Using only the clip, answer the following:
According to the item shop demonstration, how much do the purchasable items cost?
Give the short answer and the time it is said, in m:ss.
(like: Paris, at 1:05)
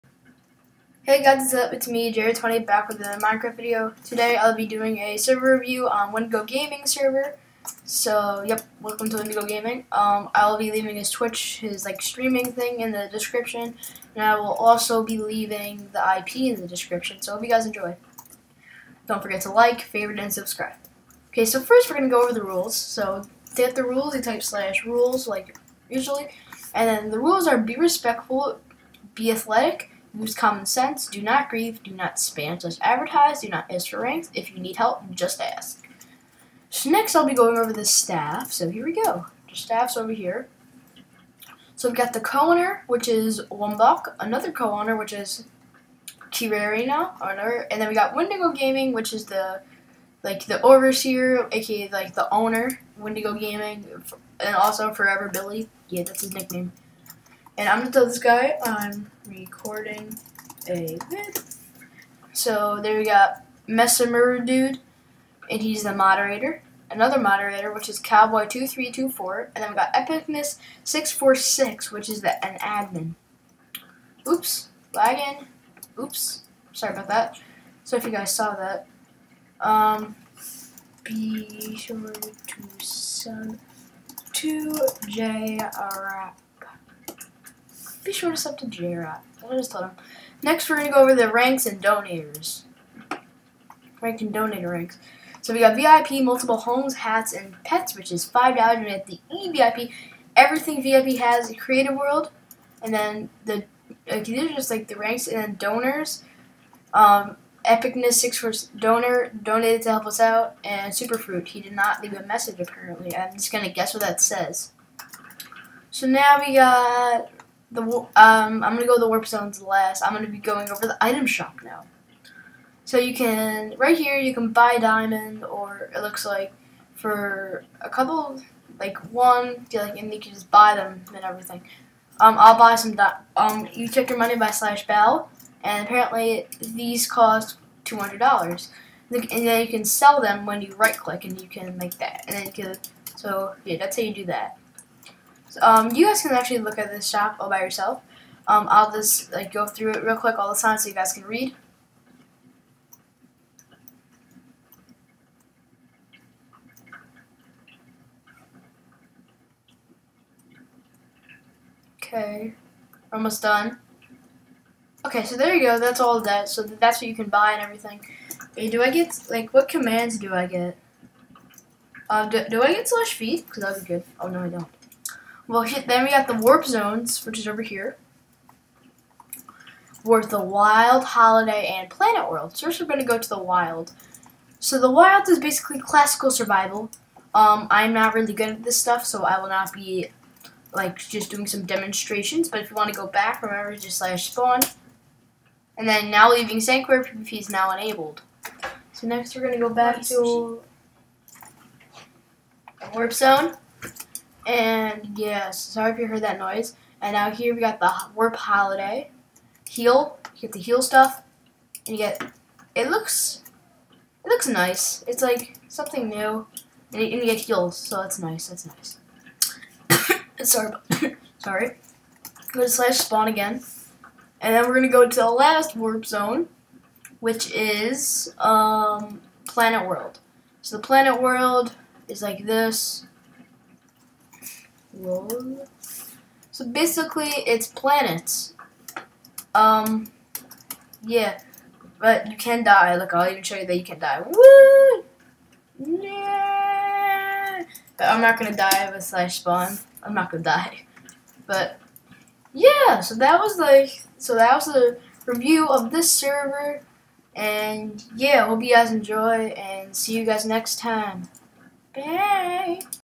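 200 dollars, at 2:17.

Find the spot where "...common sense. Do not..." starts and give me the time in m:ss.
0:30.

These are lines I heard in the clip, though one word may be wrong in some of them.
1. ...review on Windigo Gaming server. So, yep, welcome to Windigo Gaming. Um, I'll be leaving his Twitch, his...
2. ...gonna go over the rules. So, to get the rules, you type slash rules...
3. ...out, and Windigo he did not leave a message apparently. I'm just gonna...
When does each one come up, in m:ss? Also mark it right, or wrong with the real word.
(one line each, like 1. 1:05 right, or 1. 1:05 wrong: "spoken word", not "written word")
1. 0:05 right
2. 0:21 right
3. 1:50 wrong: "Superfruit", not "Windigo".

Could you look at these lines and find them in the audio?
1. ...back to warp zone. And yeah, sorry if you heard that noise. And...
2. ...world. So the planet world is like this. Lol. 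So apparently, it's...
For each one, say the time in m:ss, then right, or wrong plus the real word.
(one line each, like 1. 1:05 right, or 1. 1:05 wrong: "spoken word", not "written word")
1. 3:19 right
2. 3:49 wrong: "basically", not "apparently".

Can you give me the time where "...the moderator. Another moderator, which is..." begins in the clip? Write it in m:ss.
1:05.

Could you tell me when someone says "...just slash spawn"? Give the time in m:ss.
3:13.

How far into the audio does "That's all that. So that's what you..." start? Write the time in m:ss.
2:45.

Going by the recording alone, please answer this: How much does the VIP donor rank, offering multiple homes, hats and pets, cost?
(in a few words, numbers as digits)
$5.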